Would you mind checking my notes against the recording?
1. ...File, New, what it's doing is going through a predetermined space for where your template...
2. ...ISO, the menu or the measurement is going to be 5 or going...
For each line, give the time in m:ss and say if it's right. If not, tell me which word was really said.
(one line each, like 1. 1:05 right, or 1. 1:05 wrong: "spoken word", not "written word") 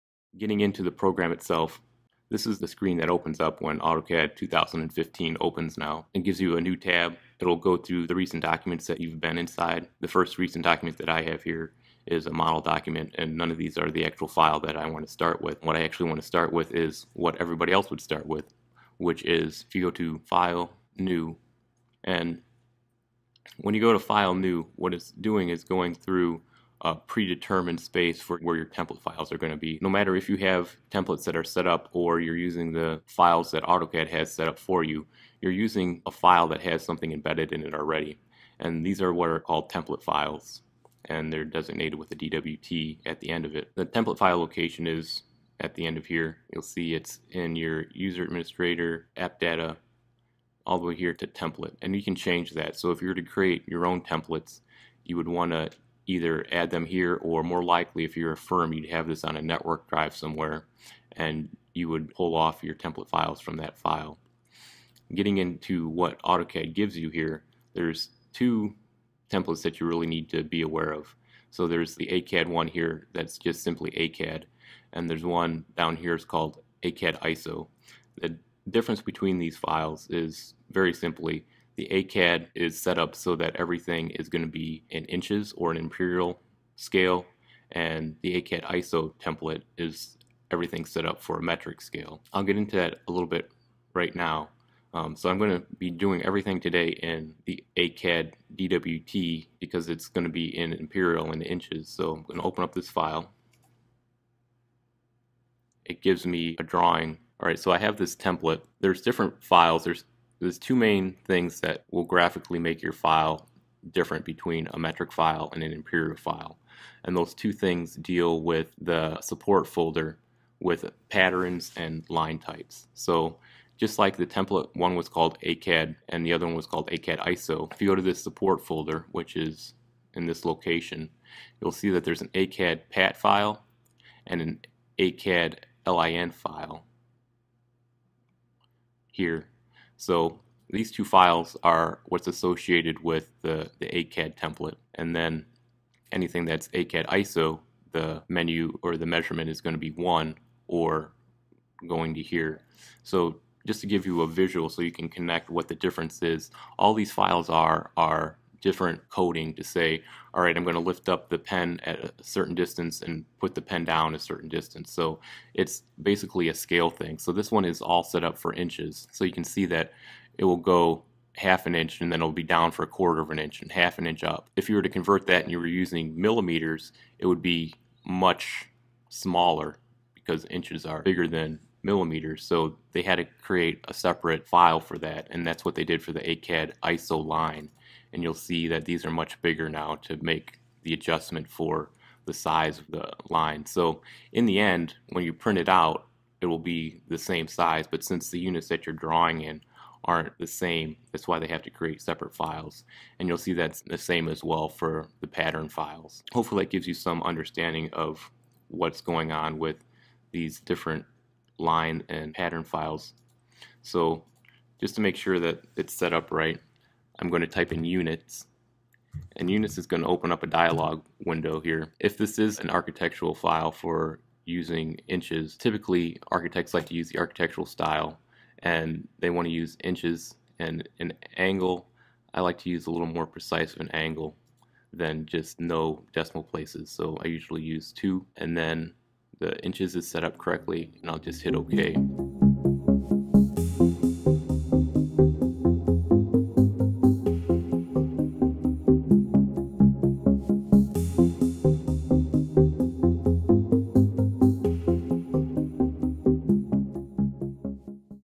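1. 0:23 right
2. 2:27 wrong: "1", not "5".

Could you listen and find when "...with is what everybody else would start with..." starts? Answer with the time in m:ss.
0:16.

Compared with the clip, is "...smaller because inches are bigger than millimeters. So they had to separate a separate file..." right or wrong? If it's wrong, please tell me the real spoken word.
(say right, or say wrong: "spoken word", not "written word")
wrong: "create", not "separate".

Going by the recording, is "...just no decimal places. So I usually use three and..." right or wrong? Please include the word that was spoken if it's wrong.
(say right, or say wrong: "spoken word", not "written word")
wrong: "two", not "three".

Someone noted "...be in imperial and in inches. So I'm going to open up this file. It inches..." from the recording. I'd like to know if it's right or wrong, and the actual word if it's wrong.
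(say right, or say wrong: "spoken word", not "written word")
wrong: "gives", not "inches".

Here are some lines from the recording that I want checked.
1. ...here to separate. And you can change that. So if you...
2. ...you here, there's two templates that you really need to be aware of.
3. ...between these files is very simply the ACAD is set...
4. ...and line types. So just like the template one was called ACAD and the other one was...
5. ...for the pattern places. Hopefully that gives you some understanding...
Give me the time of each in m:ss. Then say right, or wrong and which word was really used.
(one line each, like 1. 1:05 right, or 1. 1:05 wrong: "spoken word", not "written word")
1. 0:50 wrong: "template", not "separate"
2. 1:06 right
3. 1:19 right
4. 2:01 right
5. 3:24 wrong: "files", not "places".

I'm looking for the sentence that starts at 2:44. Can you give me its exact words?
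So it's basically a scale thing.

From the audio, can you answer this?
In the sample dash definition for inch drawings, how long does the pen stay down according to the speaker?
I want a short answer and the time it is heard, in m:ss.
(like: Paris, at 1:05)
a quarter of an inch, at 2:52.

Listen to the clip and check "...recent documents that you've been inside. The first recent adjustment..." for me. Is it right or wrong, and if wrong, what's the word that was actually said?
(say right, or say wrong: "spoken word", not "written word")
wrong: "document", not "adjustment".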